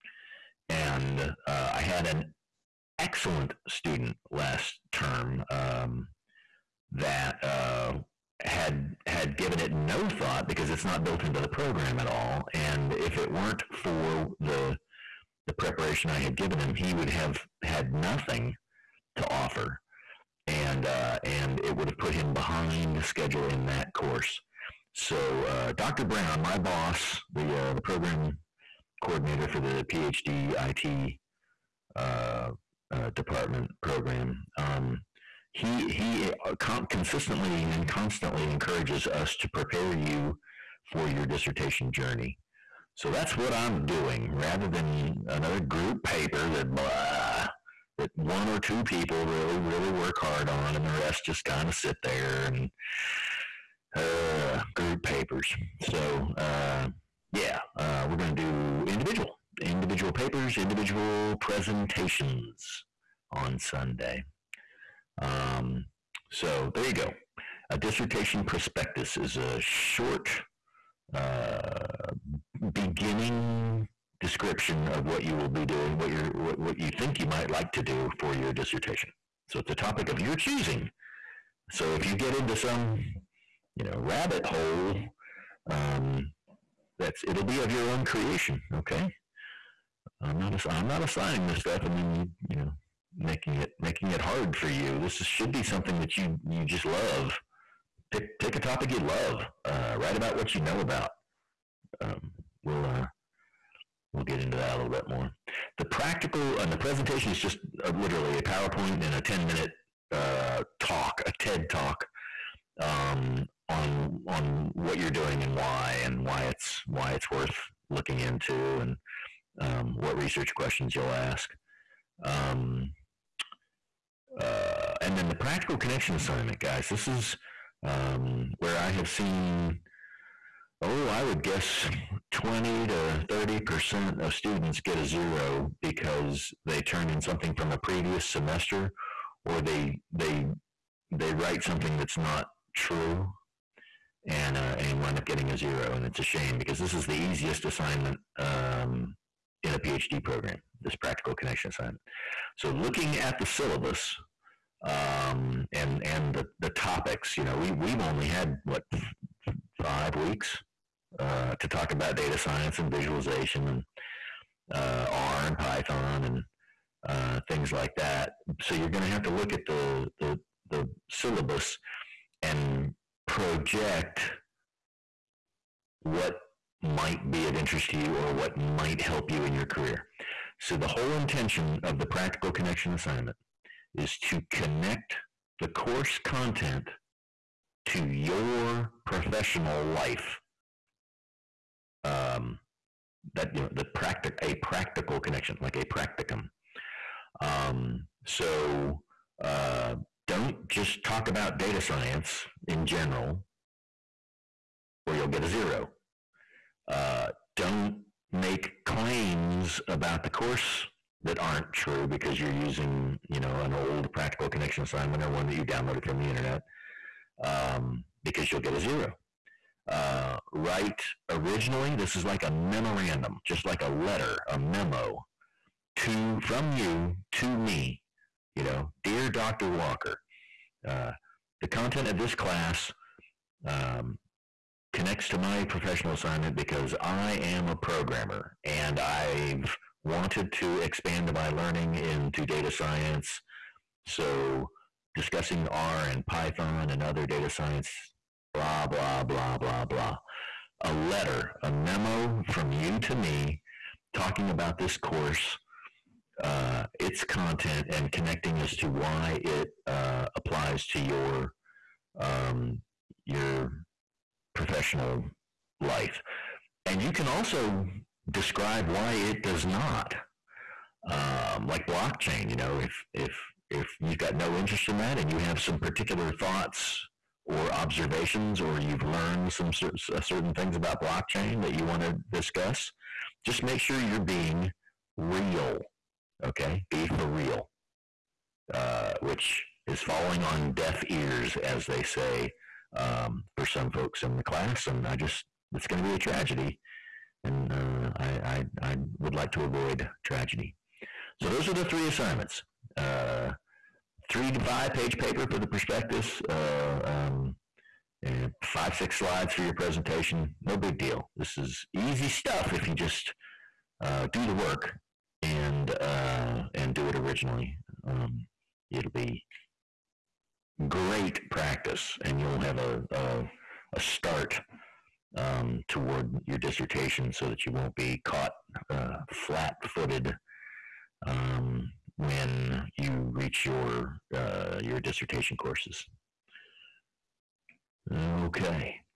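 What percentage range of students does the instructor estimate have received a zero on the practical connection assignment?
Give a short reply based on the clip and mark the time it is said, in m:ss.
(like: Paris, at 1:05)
20 to 30%, at 2:12.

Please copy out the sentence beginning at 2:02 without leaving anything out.
Um, uh, and then the practical connection assignment, guys.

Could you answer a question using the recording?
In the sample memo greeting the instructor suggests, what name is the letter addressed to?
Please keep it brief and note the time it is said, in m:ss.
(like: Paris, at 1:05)
Dr. Walker, at 3:49.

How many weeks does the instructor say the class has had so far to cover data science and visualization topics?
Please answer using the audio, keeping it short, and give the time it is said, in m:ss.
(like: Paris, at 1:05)
5, at 2:39.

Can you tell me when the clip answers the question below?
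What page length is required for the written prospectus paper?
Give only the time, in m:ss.
5:04.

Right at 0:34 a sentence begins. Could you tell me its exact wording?
Um, he he uh, con- consistently and constantly encourages us to prepare you for your dissertation journey.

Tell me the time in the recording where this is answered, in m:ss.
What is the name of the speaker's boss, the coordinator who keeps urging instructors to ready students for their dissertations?
0:25.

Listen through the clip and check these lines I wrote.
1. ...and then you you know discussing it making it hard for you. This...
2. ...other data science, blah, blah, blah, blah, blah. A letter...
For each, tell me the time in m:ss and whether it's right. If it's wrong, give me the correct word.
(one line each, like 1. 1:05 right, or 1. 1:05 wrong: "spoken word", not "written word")
1. 1:31 wrong: "making", not "discussing"
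2. 4:07 right.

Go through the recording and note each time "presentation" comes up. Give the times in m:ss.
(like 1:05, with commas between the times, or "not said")
1:01, 1:46, 5:09.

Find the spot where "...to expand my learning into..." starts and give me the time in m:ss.
4:00.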